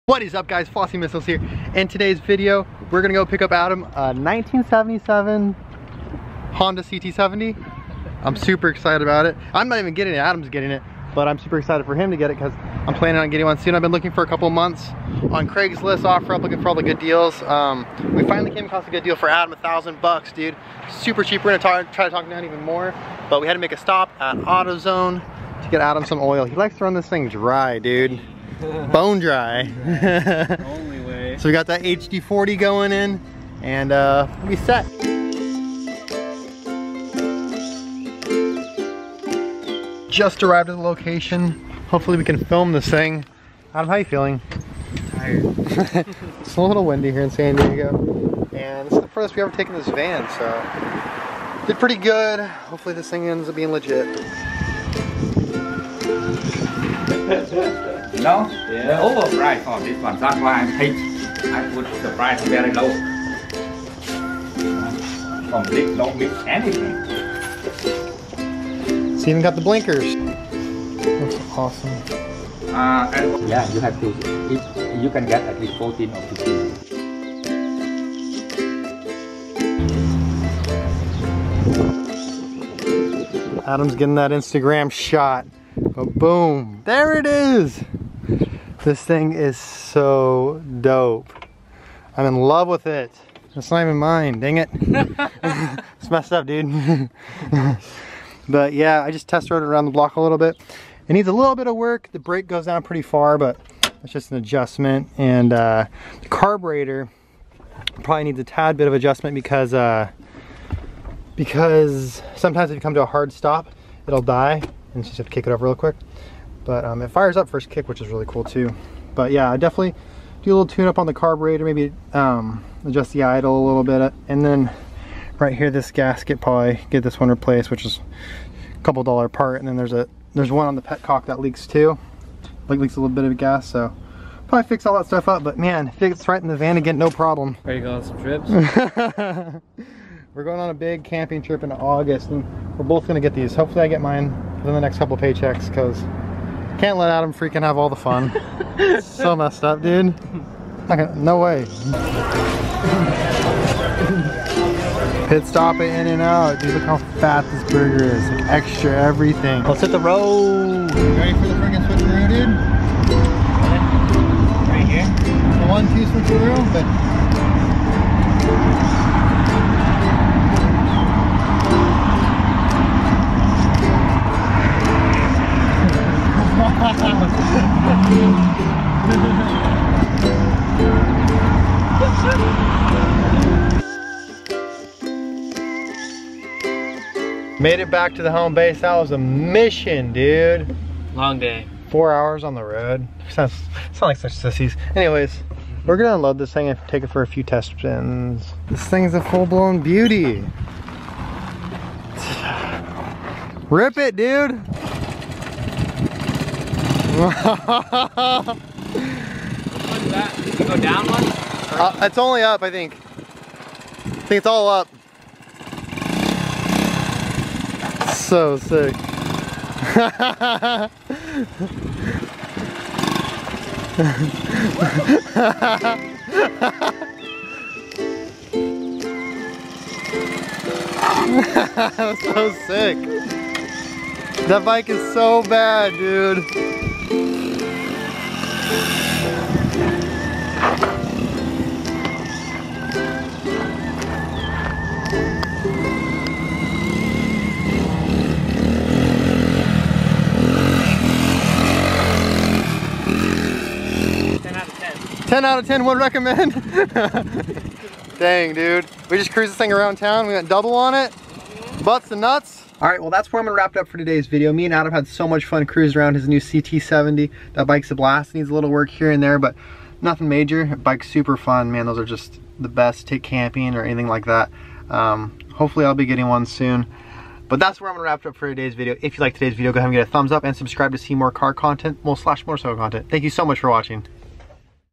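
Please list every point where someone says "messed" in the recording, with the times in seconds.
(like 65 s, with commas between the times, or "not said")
96 s, 149 s.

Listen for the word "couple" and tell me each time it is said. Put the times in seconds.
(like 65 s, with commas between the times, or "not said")
14 s, 128 s, 144 s.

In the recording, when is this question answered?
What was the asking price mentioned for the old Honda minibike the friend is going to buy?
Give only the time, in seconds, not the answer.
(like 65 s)
19 s.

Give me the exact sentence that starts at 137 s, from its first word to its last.
Are you going on some trips?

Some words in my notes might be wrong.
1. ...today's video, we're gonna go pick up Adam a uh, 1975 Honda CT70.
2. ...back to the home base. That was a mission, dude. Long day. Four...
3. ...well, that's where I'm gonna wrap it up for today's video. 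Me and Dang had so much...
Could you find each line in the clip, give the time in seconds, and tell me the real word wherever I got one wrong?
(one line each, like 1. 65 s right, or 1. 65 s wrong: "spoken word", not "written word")
1. 1 s wrong: "1977", not "1975"
2. 187 s right
3. 262 s wrong: "Adam", not "Dang".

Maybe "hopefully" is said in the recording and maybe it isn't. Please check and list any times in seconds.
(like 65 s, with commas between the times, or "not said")
41 s, 52 s, 143 s, 275 s.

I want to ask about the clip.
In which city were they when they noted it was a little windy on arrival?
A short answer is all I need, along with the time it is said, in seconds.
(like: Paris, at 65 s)
San Diego, at 47 s.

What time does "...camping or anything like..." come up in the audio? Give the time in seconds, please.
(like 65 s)
273 s.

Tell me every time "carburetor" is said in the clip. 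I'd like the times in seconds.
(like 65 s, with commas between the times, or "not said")
106 s, 121 s.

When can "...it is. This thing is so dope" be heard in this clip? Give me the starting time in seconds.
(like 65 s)
87 s.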